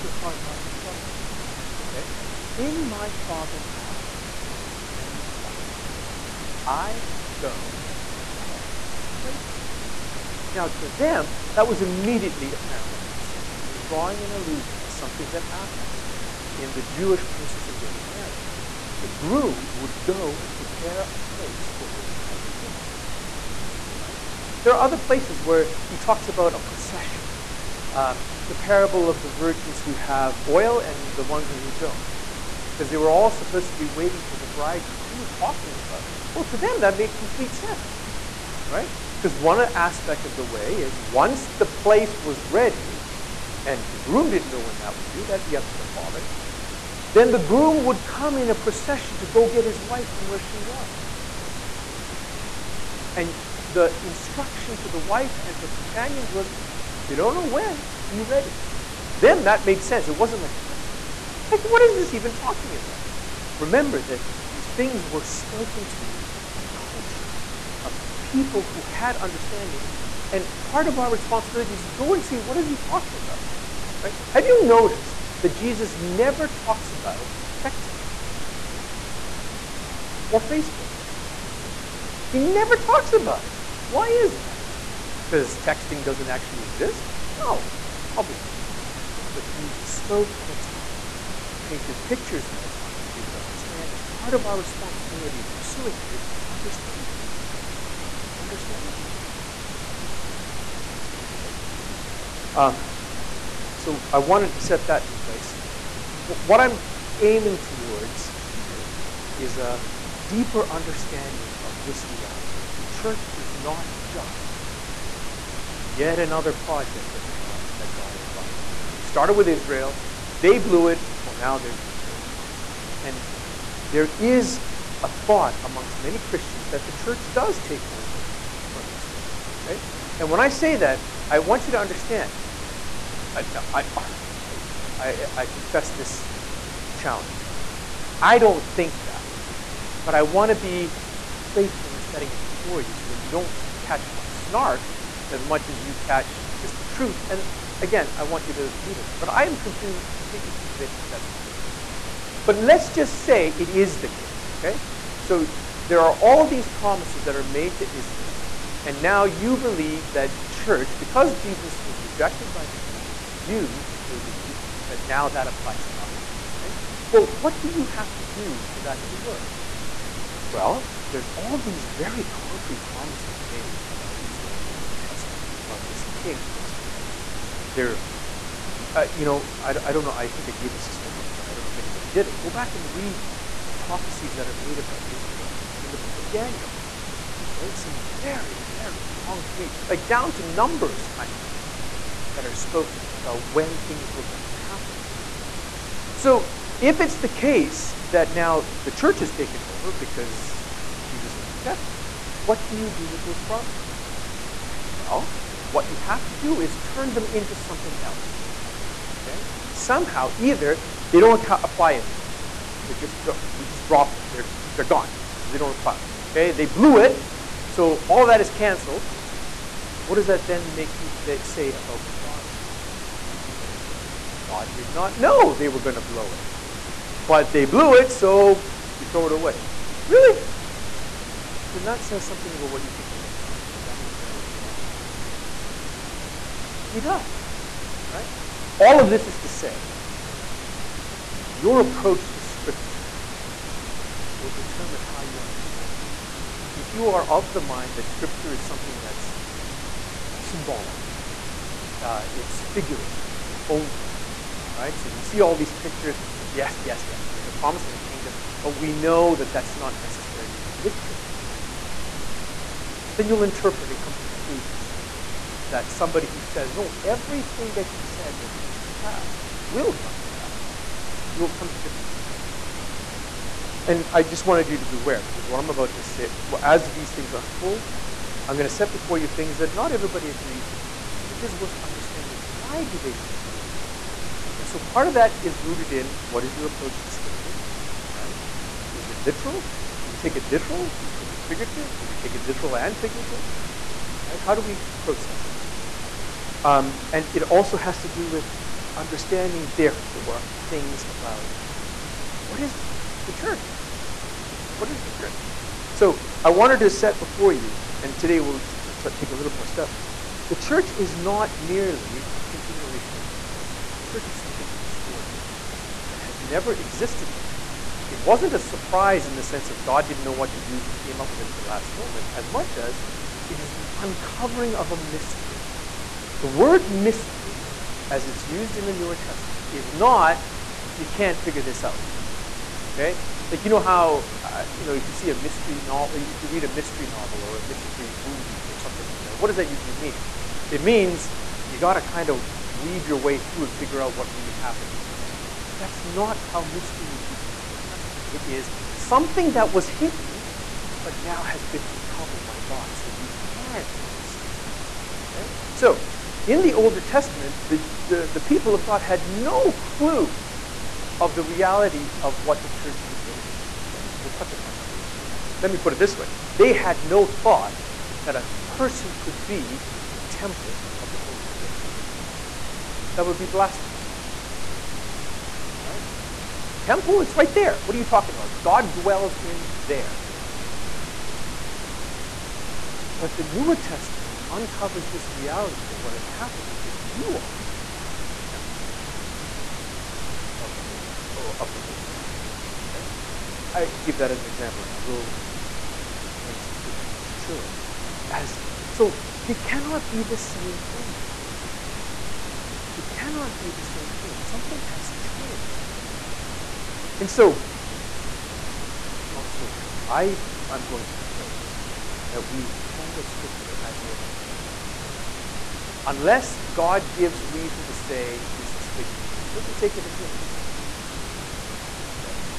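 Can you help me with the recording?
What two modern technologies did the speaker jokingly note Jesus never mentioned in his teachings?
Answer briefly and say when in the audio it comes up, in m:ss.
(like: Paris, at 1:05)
texting or Facebook, at 1:17.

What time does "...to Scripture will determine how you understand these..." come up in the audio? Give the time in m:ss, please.
4:02.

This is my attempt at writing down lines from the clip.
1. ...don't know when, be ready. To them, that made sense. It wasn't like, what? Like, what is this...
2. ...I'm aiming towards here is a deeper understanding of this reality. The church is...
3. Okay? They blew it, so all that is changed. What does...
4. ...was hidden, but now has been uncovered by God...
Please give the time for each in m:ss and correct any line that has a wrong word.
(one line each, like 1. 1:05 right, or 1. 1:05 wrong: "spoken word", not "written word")
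1. 0:57 right
2. 1:46 right
3. 3:36 wrong: "canceled", not "changed"
4. 5:49 right.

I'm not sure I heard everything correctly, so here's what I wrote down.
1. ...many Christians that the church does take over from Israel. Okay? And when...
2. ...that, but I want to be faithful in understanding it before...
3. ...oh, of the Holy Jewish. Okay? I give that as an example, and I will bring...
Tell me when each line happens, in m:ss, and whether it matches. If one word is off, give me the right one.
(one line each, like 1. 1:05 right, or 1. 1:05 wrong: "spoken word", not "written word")
1. 2:05 right
2. 2:19 wrong: "setting", not "understanding"
3. 6:31 wrong: "Spirit", not "Jewish".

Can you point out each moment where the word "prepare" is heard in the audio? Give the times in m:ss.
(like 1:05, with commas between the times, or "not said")
0:08, 0:20.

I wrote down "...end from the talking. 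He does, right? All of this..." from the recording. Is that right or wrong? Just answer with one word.
wrong.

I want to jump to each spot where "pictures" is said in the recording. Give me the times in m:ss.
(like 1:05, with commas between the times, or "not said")
1:32, 4:15.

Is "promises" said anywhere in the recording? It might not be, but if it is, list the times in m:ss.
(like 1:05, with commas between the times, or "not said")
2:36, 2:52, 3:23, 4:17.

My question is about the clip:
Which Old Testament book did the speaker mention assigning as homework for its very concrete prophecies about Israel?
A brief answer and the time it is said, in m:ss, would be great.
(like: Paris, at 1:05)
Daniel, at 3:06.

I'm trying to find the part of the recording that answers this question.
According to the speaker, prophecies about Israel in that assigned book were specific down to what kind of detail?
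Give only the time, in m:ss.
3:10.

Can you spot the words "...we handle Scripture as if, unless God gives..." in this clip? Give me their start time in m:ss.
6:52.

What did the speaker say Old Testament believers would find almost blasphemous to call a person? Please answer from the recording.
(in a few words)
temple of the Holy Spirit.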